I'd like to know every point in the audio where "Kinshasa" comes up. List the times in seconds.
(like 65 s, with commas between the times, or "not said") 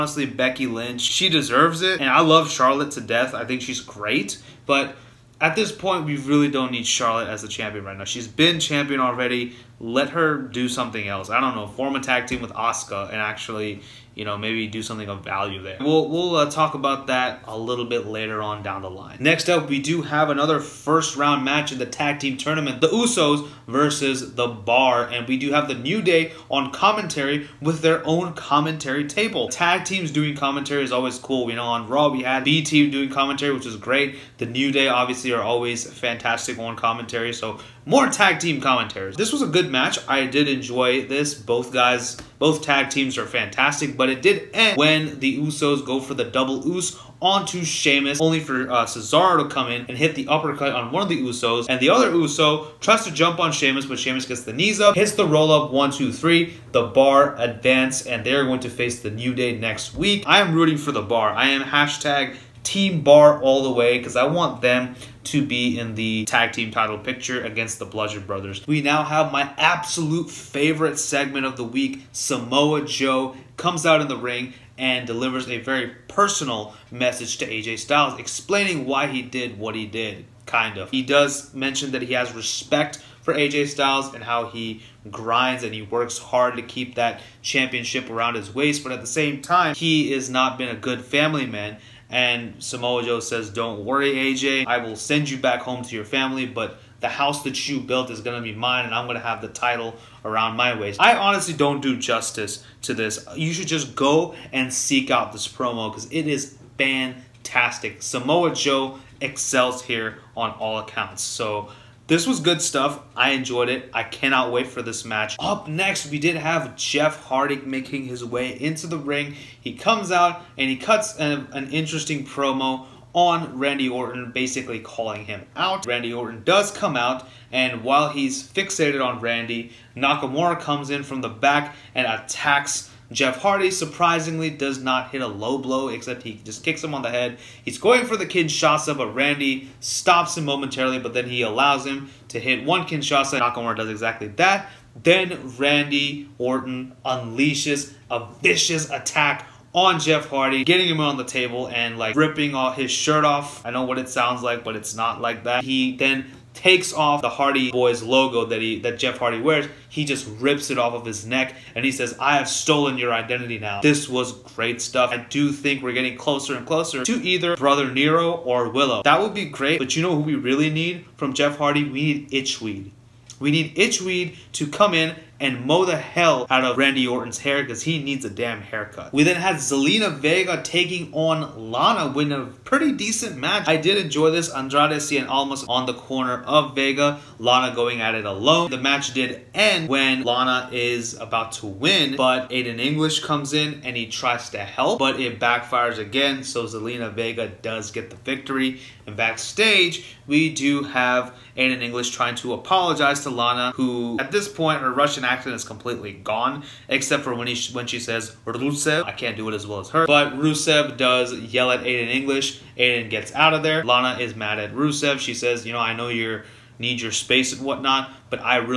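138 s, 142 s.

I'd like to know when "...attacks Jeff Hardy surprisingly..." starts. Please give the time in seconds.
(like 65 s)
132 s.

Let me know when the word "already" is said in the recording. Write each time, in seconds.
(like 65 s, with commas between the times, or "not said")
8 s.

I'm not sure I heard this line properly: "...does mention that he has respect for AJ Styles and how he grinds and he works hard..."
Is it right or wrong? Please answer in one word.
right.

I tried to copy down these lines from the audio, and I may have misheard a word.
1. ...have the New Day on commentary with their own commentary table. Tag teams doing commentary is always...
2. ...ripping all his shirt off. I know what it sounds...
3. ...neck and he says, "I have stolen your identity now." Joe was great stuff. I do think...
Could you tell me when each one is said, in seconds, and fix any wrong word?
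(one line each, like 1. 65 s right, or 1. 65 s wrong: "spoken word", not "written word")
1. 25 s right
2. 152 s right
3. 161 s wrong: "This", not "Joe".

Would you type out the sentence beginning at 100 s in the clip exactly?
I honestly don't do justice to this.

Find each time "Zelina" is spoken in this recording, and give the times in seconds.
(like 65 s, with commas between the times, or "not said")
179 s, 196 s.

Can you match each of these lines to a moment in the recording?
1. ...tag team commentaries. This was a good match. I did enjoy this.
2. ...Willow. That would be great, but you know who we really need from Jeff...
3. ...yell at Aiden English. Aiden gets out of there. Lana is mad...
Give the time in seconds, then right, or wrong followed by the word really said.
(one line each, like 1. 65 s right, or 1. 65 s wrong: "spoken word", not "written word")
1. 38 s right
2. 168 s right
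3. 211 s right.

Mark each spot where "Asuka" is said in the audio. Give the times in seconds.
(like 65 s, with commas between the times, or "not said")
12 s.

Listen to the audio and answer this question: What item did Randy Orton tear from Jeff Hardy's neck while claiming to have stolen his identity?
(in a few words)
Hardy Boys logo.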